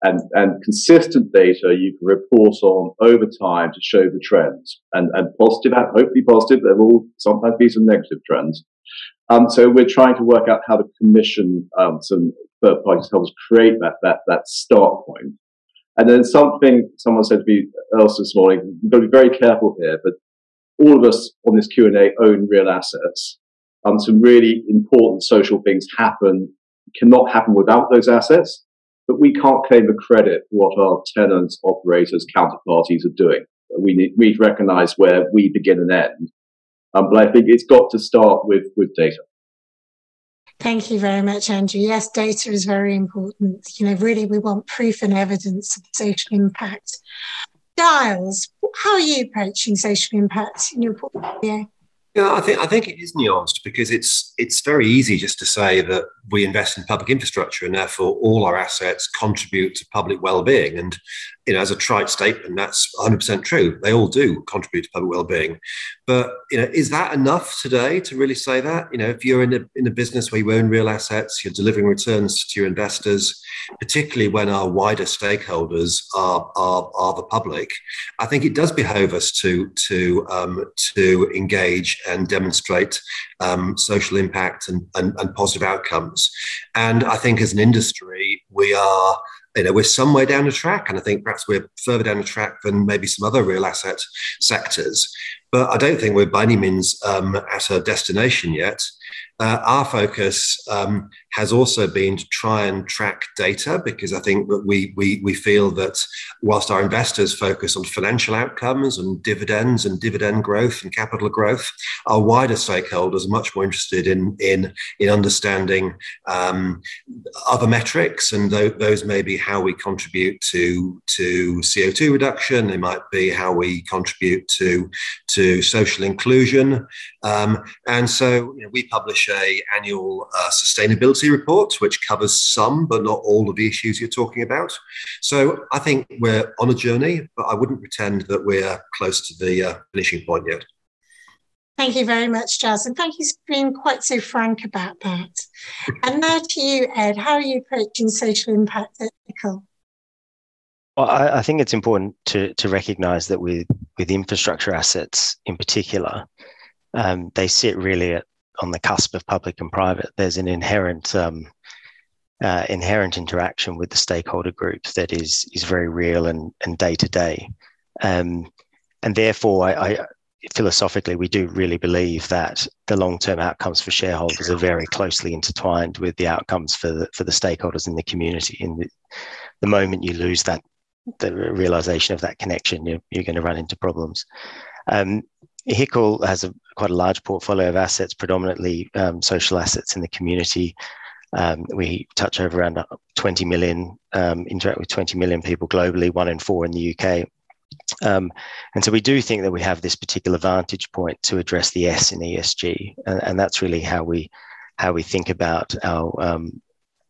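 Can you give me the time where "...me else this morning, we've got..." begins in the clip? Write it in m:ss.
0:17.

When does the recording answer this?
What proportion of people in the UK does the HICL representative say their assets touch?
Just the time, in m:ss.
3:16.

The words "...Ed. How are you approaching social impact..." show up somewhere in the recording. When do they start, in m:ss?
2:26.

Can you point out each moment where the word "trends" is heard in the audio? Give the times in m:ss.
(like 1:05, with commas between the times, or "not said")
0:04, 0:08.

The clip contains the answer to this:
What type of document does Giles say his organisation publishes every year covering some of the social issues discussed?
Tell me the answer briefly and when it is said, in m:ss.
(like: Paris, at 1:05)
sustainability policy report, at 2:10.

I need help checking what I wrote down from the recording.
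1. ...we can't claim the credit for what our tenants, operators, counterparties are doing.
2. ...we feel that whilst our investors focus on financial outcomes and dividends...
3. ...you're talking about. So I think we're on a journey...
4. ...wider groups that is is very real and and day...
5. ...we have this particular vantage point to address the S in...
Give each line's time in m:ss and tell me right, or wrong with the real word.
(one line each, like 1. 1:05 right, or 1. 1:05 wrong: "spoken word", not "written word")
1. 0:29 right
2. 1:45 right
3. 2:14 right
4. 2:43 wrong: "stakeholder", not "wider"
5. 3:19 right.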